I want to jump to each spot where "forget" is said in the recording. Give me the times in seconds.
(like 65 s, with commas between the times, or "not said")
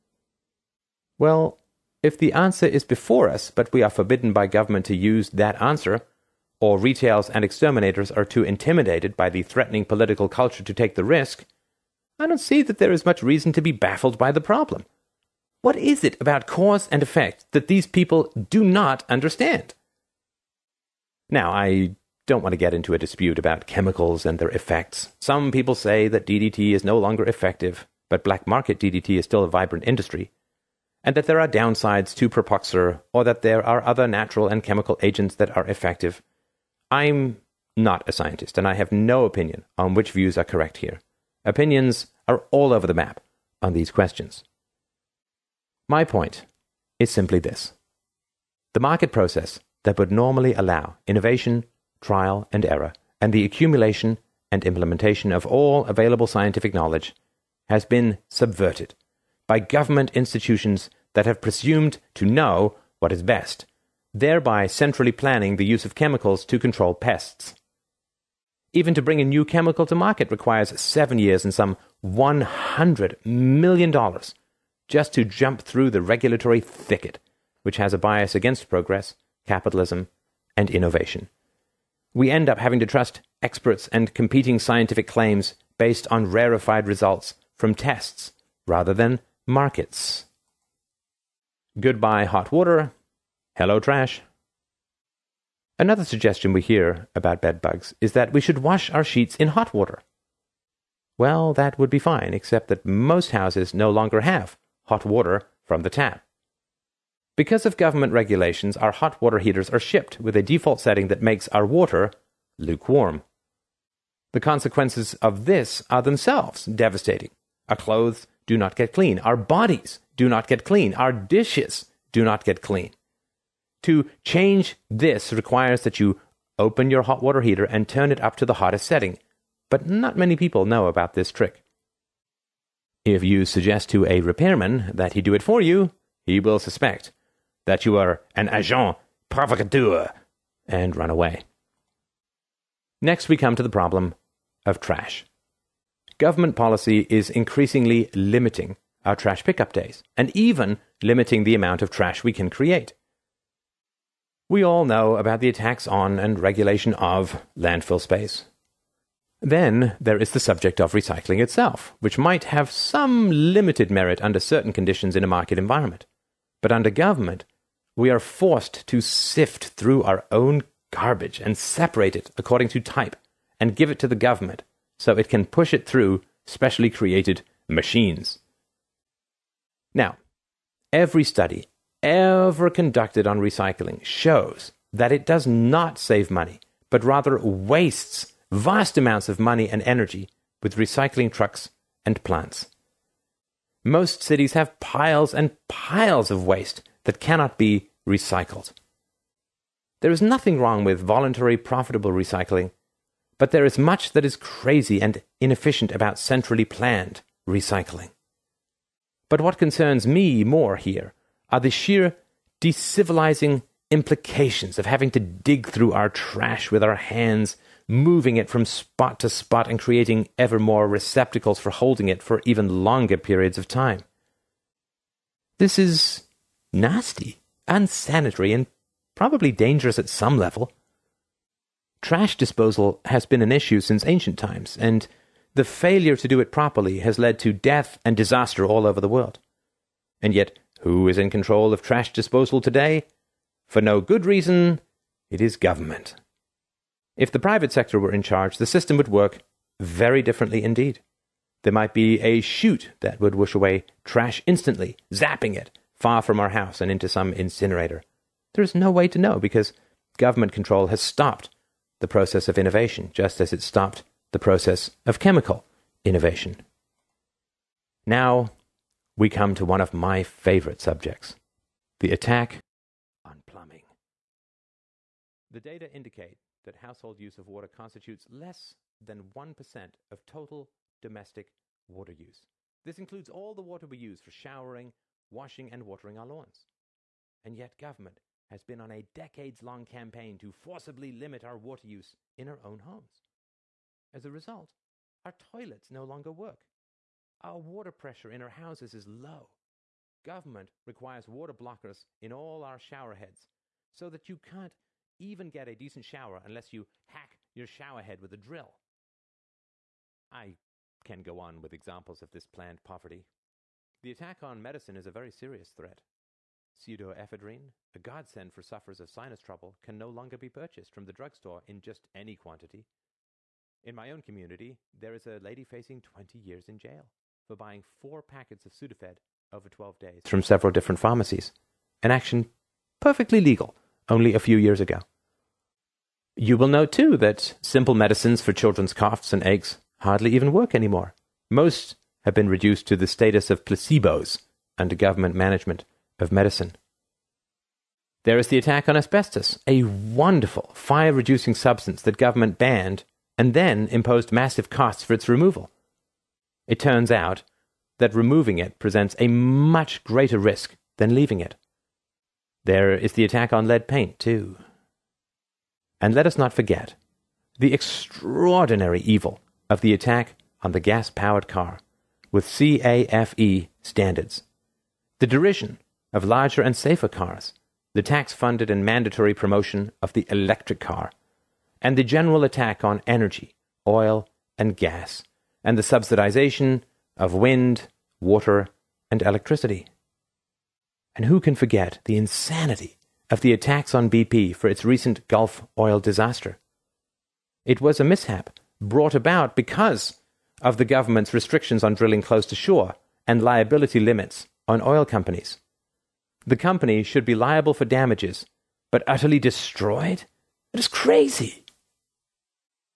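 366 s, 391 s.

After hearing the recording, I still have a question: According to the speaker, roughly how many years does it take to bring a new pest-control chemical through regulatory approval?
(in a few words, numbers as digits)
7.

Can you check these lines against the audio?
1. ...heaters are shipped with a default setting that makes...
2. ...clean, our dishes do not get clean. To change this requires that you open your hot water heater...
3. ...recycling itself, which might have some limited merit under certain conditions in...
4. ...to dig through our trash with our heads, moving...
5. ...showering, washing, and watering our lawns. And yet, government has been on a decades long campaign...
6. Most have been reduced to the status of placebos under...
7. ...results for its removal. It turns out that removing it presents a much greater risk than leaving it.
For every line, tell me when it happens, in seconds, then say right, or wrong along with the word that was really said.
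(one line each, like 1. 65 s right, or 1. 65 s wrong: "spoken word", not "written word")
1. 109 s right
2. 120 s right
3. 160 s right
4. 215 s wrong: "hands", not "heads"
5. 284 s right
6. 341 s right
7. 354 s wrong: "costs", not "results".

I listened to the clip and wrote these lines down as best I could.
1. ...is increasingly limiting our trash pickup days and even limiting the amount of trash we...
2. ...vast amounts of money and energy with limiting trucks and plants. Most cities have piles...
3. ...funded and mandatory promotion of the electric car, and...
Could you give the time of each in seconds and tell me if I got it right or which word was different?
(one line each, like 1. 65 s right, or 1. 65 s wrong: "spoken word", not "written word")
1. 147 s right
2. 188 s wrong: "recycling", not "limiting"
3. 378 s right.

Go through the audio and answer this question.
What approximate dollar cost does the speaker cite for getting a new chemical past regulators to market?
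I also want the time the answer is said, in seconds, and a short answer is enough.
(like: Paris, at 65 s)
$100 million, at 72 s.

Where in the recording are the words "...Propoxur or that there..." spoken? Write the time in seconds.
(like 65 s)
32 s.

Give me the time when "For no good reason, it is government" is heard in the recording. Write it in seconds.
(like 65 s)
243 s.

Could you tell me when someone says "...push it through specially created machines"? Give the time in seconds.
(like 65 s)
175 s.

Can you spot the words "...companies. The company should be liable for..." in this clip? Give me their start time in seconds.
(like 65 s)
405 s.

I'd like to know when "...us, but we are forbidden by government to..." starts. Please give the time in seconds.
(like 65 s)
3 s.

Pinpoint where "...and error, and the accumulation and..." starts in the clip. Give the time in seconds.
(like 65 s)
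52 s.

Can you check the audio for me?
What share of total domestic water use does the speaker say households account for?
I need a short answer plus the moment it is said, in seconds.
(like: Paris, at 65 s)
less than 1%, at 278 s.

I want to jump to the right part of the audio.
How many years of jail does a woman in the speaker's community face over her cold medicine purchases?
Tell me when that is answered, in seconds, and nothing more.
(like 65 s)
326 s.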